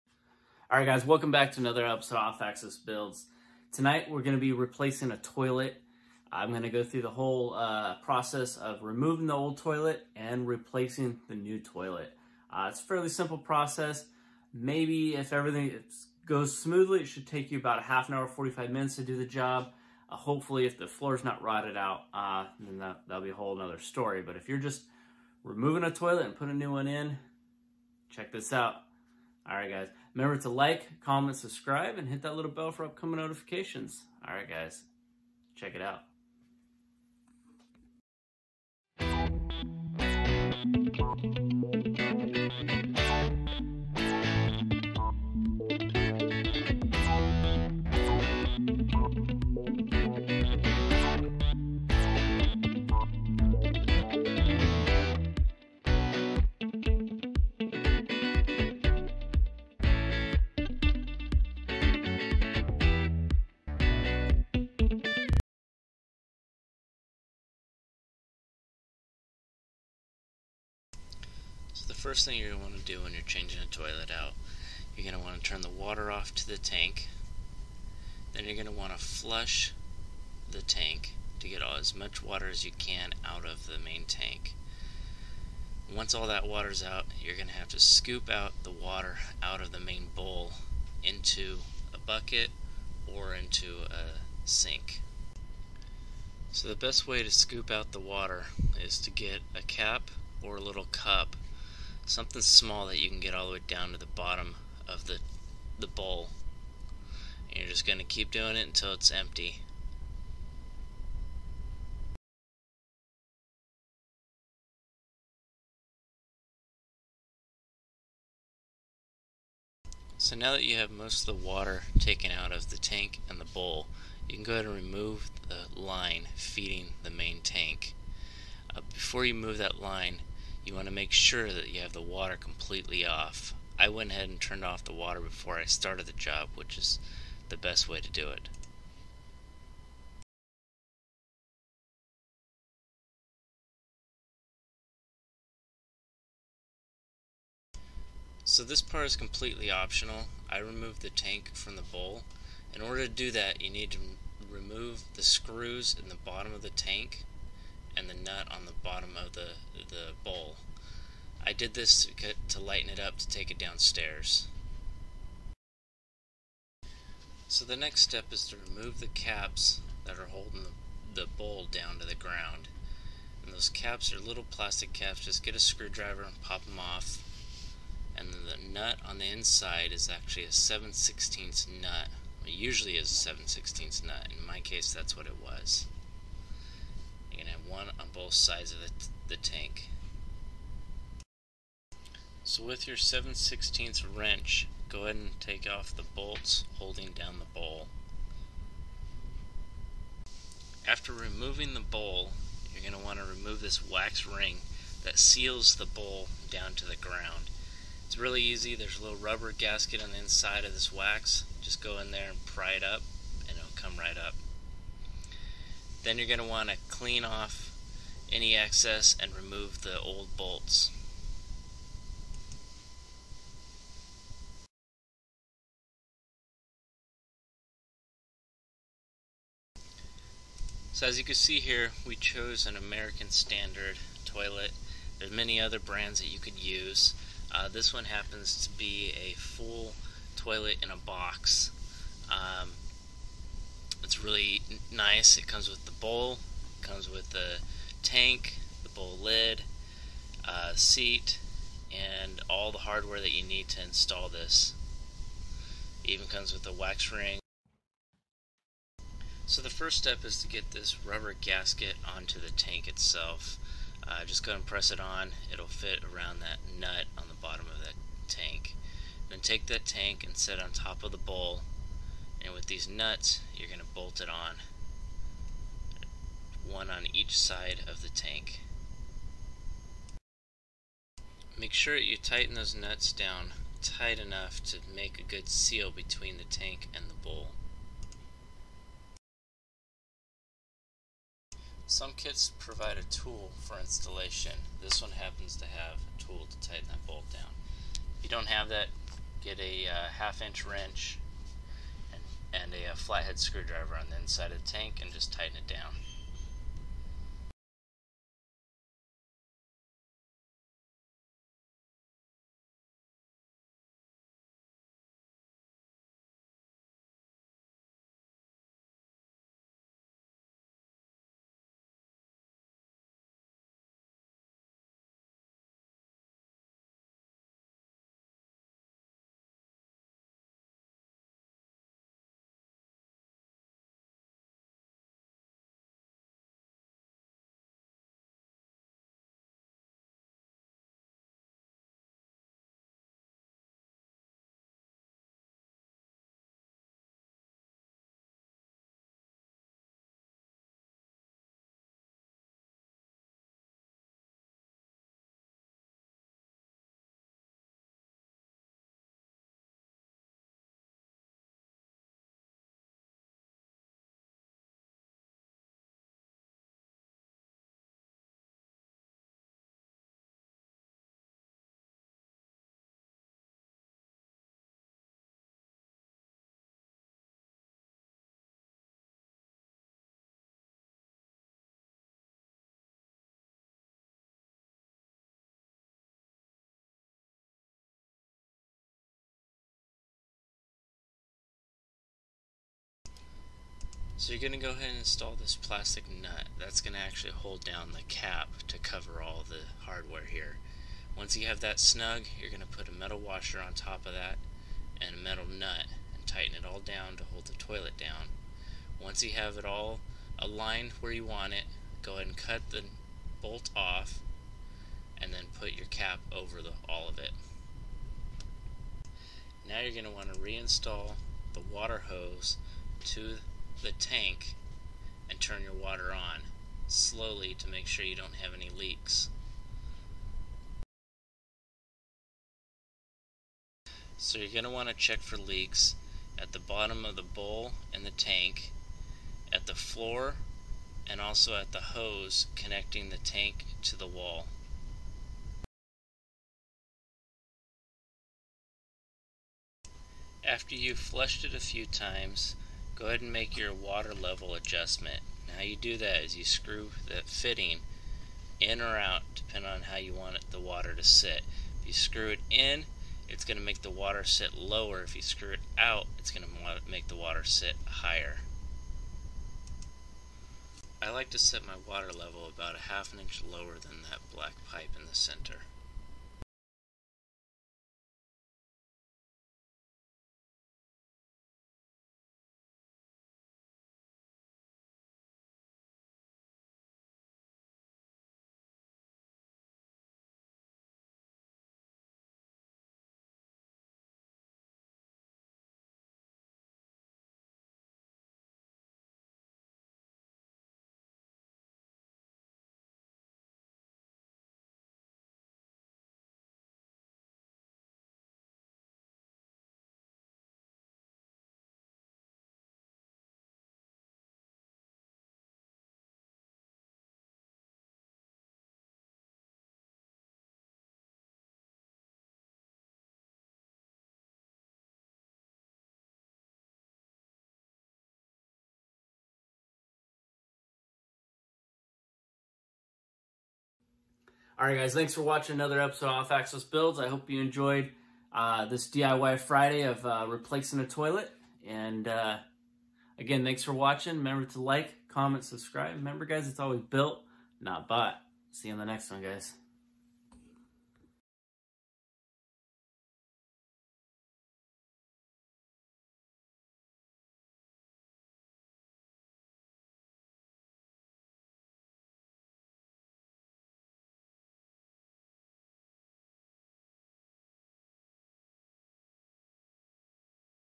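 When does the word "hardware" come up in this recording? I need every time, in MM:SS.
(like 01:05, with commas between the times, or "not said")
04:12, 06:39.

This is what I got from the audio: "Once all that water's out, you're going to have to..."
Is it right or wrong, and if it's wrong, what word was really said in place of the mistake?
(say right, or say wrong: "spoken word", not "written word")
right.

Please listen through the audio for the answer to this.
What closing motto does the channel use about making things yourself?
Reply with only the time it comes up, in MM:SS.
09:06.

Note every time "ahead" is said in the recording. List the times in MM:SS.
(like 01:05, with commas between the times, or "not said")
02:04, 02:14, 03:15, 06:34, 06:52, 07:33.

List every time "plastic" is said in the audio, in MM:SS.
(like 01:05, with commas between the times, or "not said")
02:54, 06:35.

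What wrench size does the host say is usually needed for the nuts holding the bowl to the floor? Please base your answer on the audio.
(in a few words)
7/16.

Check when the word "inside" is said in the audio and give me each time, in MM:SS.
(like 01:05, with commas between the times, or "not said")
02:59, 03:30, 05:04.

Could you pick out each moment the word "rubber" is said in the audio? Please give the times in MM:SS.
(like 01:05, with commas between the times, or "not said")
03:29, 04:21.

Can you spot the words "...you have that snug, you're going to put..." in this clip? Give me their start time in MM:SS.
06:41.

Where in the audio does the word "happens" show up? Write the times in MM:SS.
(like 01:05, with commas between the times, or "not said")
03:58, 04:55.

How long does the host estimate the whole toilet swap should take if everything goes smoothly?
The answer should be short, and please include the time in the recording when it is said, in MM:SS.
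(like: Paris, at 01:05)
half an hour, 45 minutes, at 00:17.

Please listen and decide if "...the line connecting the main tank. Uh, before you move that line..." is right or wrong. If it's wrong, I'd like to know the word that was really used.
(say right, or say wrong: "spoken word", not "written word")
wrong: "feeding", not "connecting".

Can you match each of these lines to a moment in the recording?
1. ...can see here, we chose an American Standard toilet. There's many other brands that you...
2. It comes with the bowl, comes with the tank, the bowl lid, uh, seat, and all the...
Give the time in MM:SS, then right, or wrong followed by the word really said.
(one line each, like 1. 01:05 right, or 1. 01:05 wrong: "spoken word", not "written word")
1. 03:51 right
2. 04:05 right.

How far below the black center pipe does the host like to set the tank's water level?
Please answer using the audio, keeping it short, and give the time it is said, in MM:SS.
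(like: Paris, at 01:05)
half an inch, at 07:52.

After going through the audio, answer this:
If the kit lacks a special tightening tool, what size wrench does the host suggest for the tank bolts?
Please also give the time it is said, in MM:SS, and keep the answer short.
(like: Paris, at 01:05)
half inch, at 05:00.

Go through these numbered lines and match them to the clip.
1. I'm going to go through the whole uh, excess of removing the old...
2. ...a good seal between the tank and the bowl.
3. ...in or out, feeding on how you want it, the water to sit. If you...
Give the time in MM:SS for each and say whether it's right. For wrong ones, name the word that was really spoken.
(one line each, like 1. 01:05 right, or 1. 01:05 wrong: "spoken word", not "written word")
1. 00:06 wrong: "process", not "excess"
2. 04:45 right
3. 07:38 wrong: "depending", not "feeding".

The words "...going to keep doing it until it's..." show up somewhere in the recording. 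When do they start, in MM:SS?
01:47.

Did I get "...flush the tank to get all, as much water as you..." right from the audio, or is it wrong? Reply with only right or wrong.
right.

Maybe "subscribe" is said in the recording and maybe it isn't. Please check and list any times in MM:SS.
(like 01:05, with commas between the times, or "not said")
00:31, 09:05.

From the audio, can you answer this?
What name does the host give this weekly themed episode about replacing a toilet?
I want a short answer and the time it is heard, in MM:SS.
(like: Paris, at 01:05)
DIY Friday, at 08:58.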